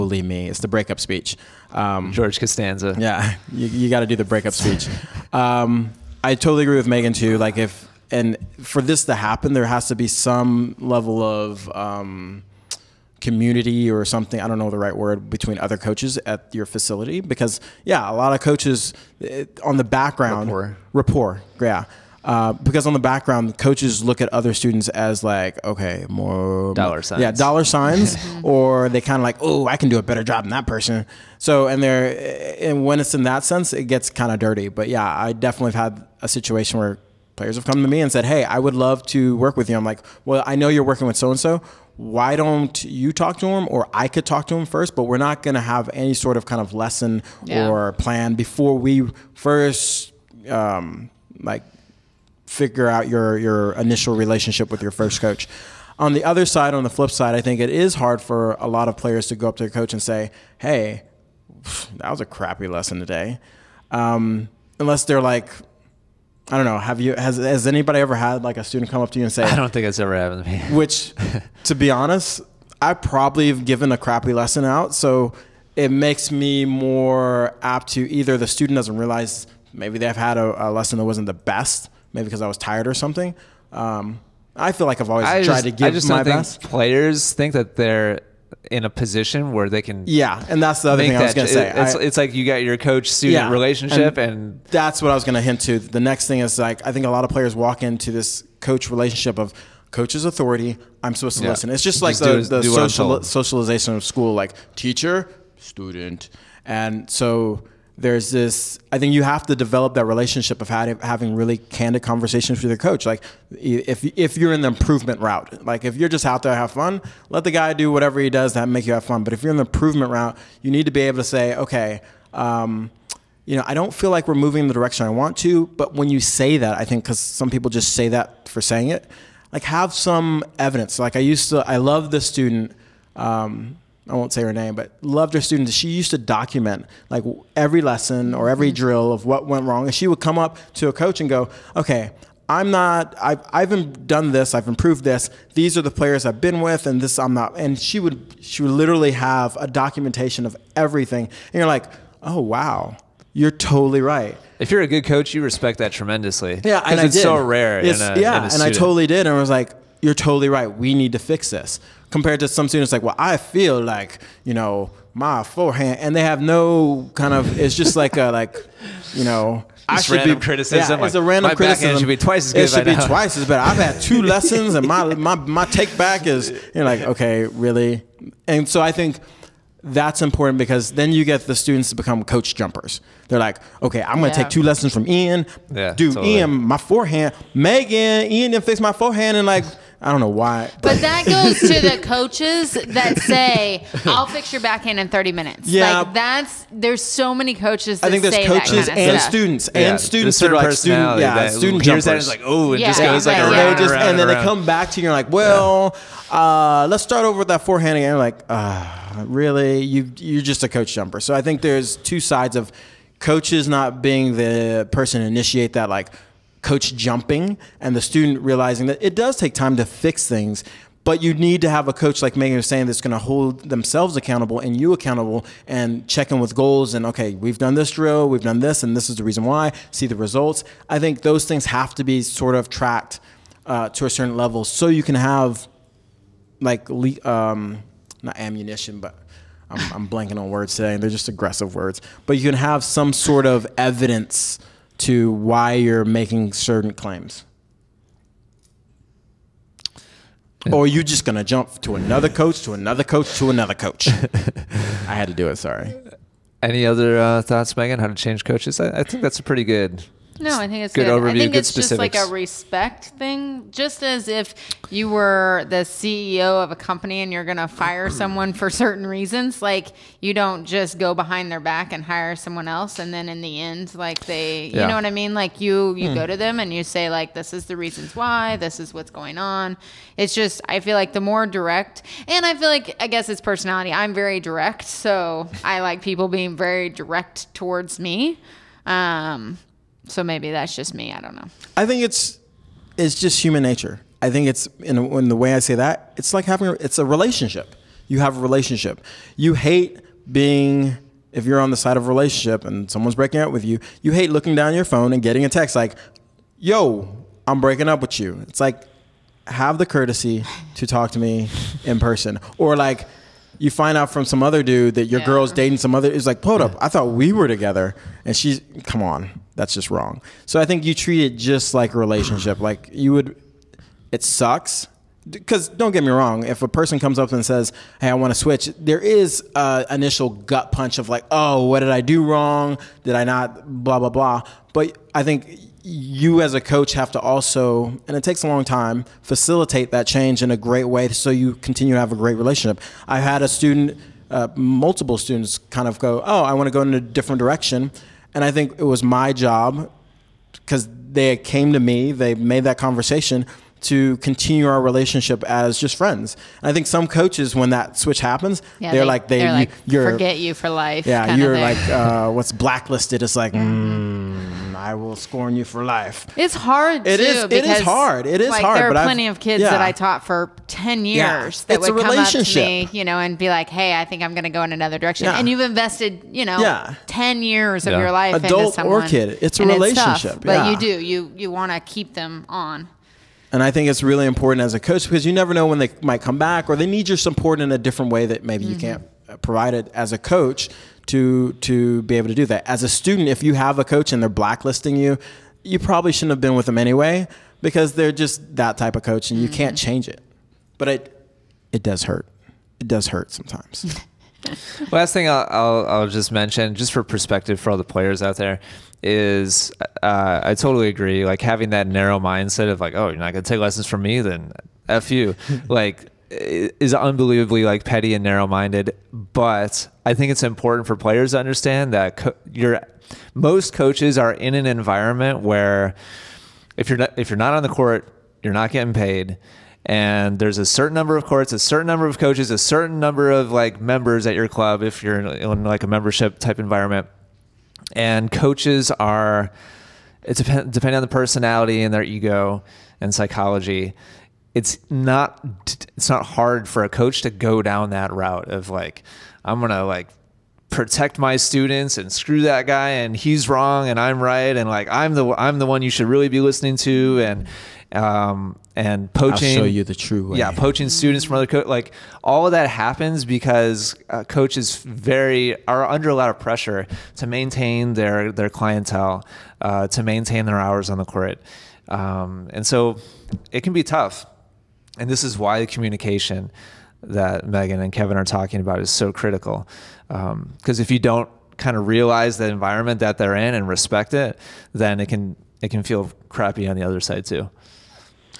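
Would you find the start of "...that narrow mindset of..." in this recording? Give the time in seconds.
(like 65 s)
411 s.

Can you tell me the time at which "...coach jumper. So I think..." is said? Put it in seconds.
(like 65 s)
210 s.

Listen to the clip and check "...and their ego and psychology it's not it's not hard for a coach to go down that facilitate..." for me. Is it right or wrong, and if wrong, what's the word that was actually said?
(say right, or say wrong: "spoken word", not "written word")
wrong: "route", not "facilitate".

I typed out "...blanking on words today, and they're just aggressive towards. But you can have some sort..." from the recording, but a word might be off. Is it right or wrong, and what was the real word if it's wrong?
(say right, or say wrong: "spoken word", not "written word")
wrong: "words", not "towards".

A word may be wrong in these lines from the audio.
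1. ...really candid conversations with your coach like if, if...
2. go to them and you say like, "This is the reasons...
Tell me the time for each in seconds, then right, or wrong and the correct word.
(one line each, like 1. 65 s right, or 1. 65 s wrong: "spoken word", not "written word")
1. 111 s right
2. 276 s right.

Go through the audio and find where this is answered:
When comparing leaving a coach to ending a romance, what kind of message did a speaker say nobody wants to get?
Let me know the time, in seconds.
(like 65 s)
305 s.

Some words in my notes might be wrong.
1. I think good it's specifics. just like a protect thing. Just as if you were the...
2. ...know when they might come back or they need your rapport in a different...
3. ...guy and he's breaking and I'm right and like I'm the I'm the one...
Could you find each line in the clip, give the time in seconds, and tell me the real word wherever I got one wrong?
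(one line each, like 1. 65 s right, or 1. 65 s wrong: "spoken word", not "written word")
1. 261 s wrong: "respect", not "protect"
2. 385 s wrong: "support", not "rapport"
3. 452 s wrong: "wrong", not "breaking".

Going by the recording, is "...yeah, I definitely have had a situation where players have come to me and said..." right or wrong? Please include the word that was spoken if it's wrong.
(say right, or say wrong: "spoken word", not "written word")
right.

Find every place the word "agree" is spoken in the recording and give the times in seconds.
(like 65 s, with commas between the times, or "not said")
6 s, 410 s.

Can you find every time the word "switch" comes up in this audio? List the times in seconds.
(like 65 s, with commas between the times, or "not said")
328 s, 357 s.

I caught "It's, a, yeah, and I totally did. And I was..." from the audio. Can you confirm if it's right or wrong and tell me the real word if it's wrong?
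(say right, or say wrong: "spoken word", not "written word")
right.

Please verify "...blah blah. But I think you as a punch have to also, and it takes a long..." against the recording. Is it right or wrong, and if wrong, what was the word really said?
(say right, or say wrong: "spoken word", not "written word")
wrong: "coach", not "punch".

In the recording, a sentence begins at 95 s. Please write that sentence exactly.
The next thing is like I think a lot of players walk into this coach relationship of coach's authority.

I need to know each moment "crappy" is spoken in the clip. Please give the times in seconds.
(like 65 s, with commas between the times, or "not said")
62 s, 73 s, 486 s.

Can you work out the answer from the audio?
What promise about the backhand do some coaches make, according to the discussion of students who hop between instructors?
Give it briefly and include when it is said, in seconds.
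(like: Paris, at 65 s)
Fix it in 30 minutes, at 194 s.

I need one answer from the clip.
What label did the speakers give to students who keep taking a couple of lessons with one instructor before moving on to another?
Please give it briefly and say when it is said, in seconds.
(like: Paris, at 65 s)
Coach jumpers, at 182 s.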